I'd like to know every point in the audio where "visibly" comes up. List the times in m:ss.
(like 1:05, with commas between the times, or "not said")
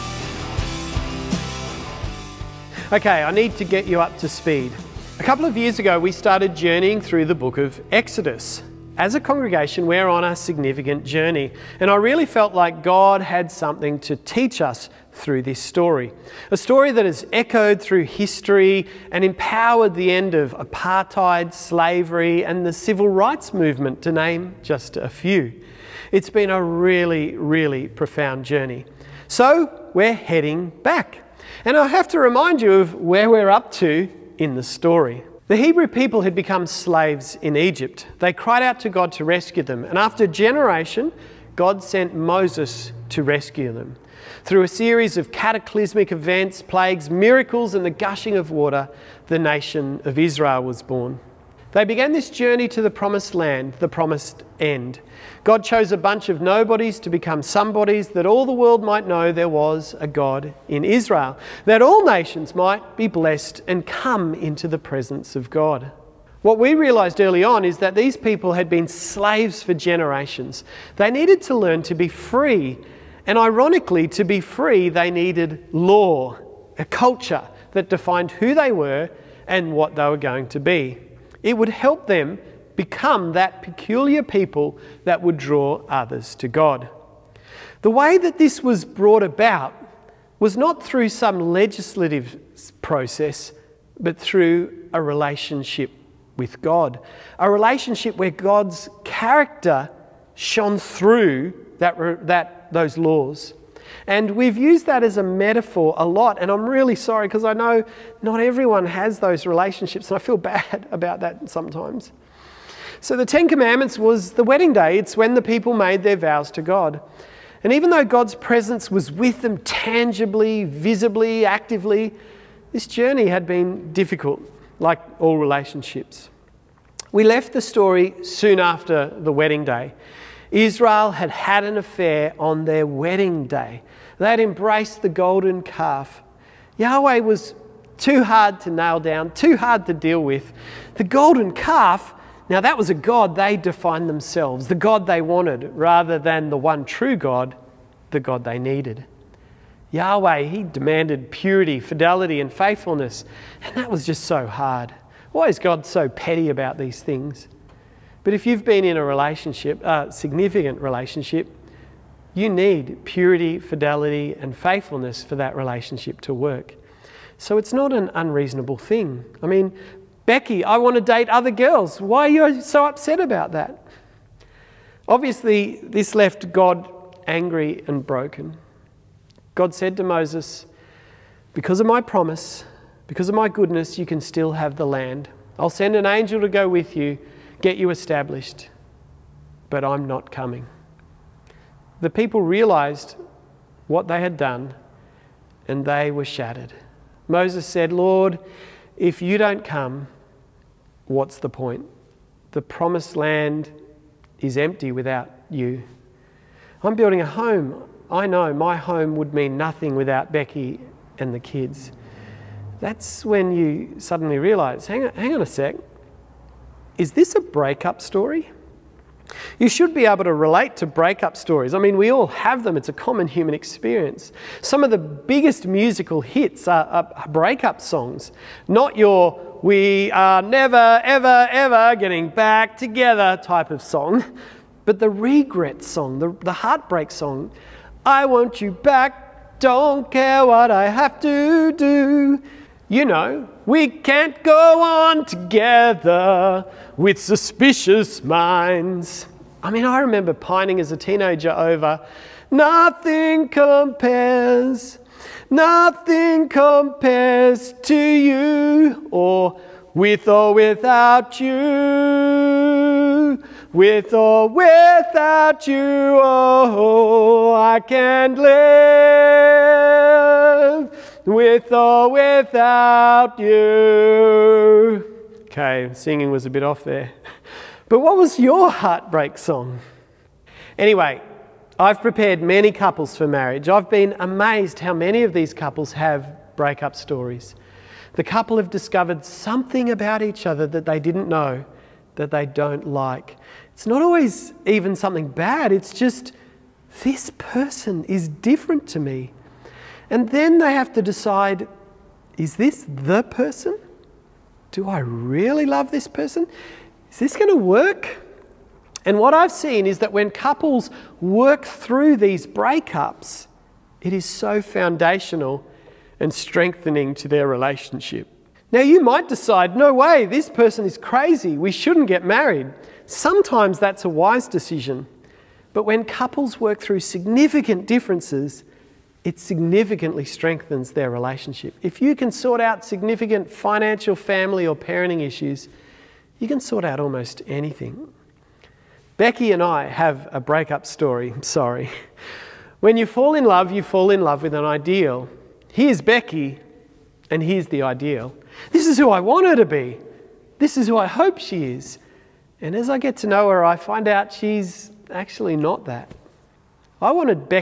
2:00.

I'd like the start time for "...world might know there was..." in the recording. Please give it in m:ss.
0:58.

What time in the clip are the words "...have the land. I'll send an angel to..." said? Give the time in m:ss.
3:04.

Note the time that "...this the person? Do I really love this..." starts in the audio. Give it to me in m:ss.
5:02.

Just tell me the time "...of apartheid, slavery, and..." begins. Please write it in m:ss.
0:20.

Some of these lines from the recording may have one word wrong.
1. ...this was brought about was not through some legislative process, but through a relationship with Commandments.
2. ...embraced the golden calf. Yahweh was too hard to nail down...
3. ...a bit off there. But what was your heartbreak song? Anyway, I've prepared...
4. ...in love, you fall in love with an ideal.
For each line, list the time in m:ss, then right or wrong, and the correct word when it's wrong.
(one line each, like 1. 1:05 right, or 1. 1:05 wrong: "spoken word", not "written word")
1. 1:28 wrong: "God", not "Commandments"
2. 2:14 right
3. 4:36 right
4. 5:43 right.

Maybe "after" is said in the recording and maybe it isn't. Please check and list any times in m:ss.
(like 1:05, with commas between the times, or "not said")
0:39, 2:08.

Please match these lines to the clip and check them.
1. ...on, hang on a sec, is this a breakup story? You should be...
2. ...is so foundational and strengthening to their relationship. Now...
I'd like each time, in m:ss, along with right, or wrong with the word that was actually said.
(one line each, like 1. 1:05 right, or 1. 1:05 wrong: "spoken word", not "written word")
1. 3:35 right
2. 5:14 right.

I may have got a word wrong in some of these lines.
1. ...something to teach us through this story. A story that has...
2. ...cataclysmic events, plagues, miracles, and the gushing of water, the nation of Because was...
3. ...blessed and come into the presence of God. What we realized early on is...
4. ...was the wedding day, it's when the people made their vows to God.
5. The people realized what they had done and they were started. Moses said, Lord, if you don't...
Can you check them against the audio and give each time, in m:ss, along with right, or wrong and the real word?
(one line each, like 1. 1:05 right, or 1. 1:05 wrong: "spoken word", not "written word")
1. 0:13 right
2. 0:45 wrong: "Israel", not "Because"
3. 1:03 right
4. 1:53 right
5. 3:12 wrong: "shattered", not "started".